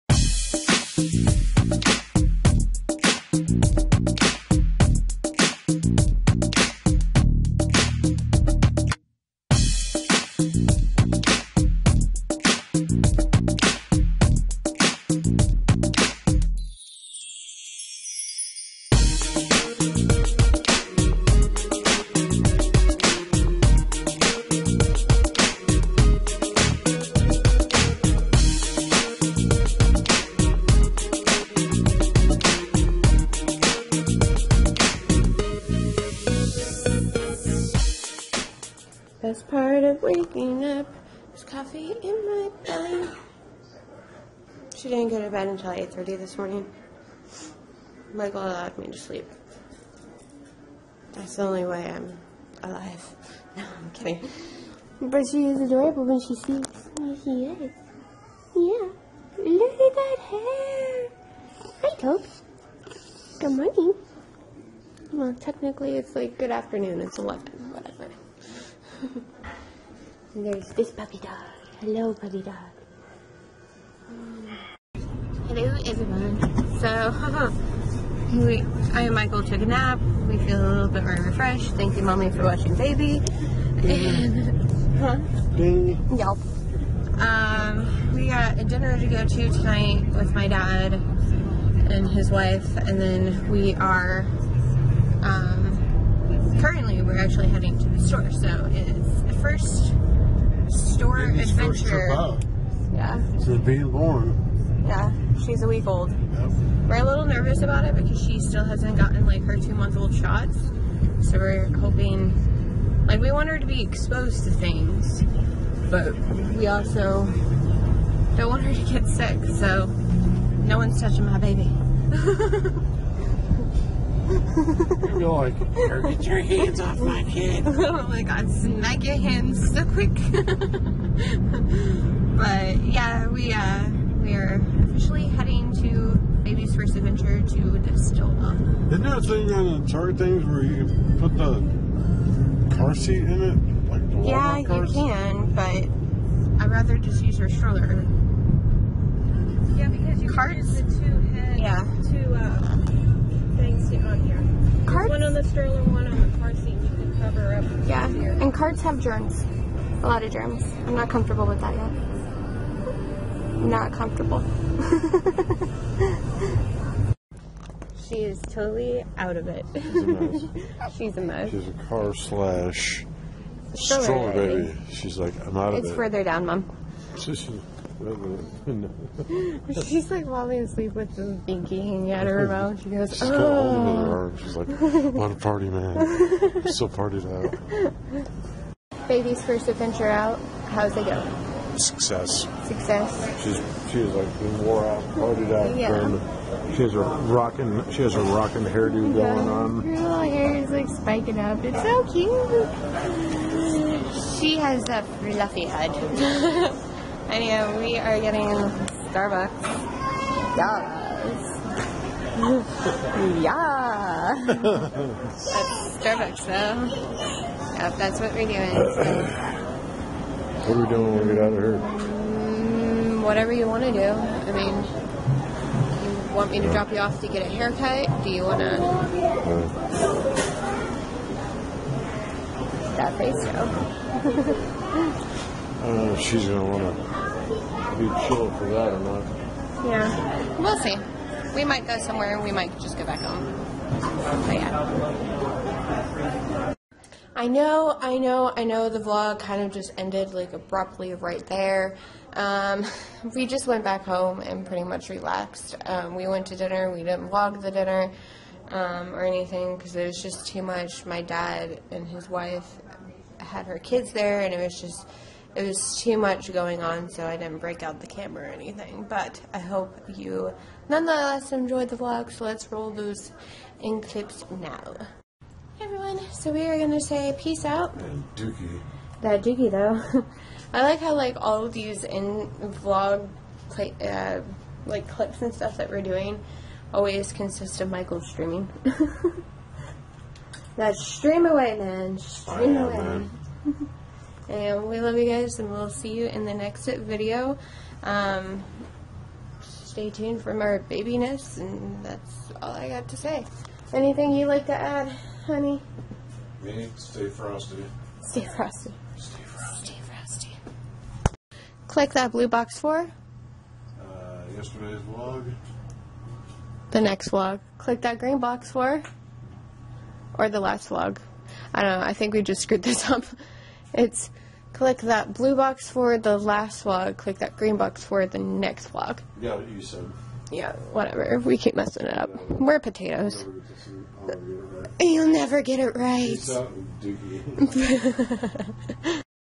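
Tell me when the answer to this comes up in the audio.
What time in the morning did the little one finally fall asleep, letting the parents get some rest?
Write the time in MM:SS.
00:45.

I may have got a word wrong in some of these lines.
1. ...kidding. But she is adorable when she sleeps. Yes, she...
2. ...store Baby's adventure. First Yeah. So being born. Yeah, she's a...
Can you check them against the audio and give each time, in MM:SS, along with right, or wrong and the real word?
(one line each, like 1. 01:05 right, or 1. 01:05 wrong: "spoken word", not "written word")
1. 00:53 right
2. 01:40 right.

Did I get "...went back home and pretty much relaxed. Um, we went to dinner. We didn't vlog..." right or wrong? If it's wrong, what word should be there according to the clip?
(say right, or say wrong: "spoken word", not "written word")
right.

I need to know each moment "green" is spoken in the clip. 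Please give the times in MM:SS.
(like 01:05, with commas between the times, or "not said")
05:18, 05:27.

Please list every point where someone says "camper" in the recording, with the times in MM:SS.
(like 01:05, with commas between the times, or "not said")
not said.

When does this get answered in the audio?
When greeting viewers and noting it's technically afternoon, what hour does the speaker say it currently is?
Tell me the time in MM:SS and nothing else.
01:07.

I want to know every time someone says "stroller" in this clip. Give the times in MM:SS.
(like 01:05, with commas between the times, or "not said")
02:27, 02:53.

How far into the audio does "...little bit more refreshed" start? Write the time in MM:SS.
01:20.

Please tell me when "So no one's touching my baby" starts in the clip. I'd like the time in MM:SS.
01:59.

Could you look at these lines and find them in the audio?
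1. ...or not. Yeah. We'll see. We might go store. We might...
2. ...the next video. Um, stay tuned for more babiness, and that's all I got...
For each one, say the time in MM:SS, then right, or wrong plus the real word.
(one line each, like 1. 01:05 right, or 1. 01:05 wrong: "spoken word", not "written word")
1. 03:58 wrong: "somewhere", not "store"
2. 04:56 right.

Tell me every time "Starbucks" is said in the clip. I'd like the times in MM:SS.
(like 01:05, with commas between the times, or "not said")
03:29, 03:36.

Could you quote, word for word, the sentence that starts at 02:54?
She's like, I'm out of it's it.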